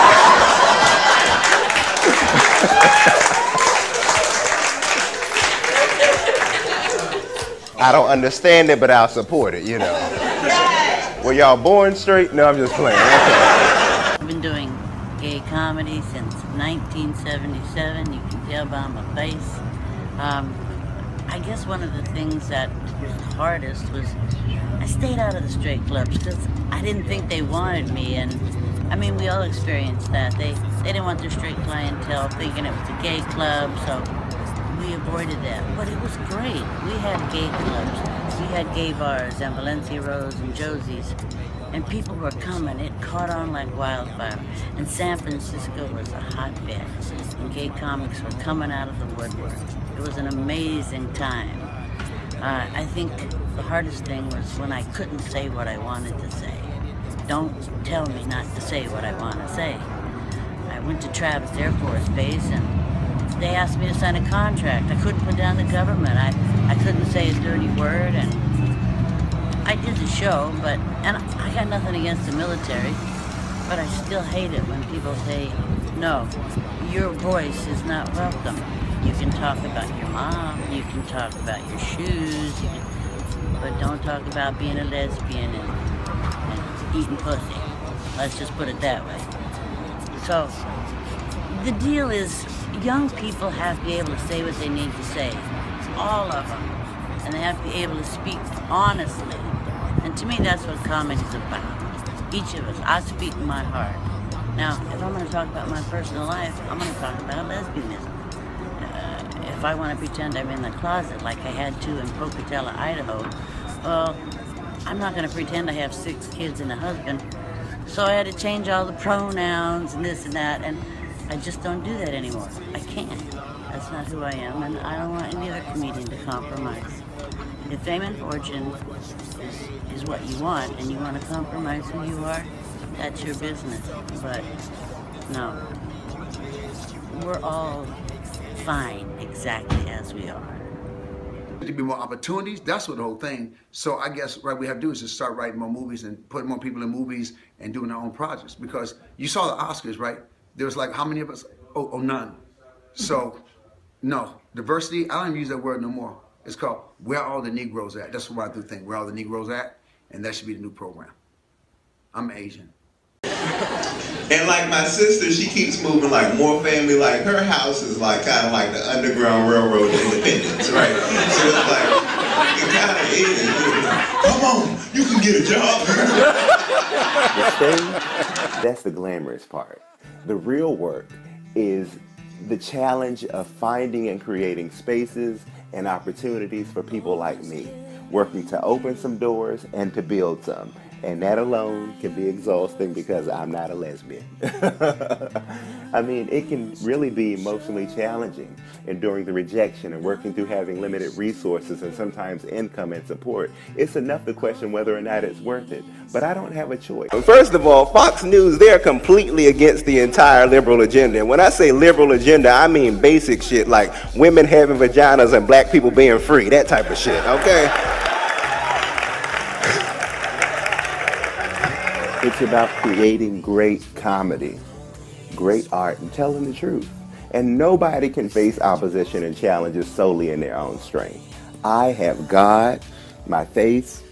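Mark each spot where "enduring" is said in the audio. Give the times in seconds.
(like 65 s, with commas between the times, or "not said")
198 s.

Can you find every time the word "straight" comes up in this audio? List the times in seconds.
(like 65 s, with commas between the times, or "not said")
11 s, 25 s, 31 s.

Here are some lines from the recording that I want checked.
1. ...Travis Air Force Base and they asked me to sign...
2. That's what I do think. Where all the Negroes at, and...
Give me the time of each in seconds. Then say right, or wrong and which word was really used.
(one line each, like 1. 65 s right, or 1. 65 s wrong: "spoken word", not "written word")
1. 61 s right
2. 158 s right.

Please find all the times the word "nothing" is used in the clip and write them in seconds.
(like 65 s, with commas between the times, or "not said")
71 s.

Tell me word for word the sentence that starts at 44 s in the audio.
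And San Francisco was a hotbed, and gay comics were coming out of the woodwork.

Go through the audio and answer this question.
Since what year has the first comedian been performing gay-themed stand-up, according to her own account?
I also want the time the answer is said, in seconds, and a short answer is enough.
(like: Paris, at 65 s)
1977, at 16 s.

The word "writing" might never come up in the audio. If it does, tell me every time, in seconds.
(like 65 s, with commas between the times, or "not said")
145 s.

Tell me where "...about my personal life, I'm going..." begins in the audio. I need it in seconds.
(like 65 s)
105 s.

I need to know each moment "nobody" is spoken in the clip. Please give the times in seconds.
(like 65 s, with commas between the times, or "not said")
227 s.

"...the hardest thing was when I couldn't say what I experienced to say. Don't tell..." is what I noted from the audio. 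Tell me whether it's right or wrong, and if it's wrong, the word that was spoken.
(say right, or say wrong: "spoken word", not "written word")
wrong: "wanted", not "experienced".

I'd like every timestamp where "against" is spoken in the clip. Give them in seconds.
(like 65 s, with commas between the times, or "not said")
71 s, 209 s.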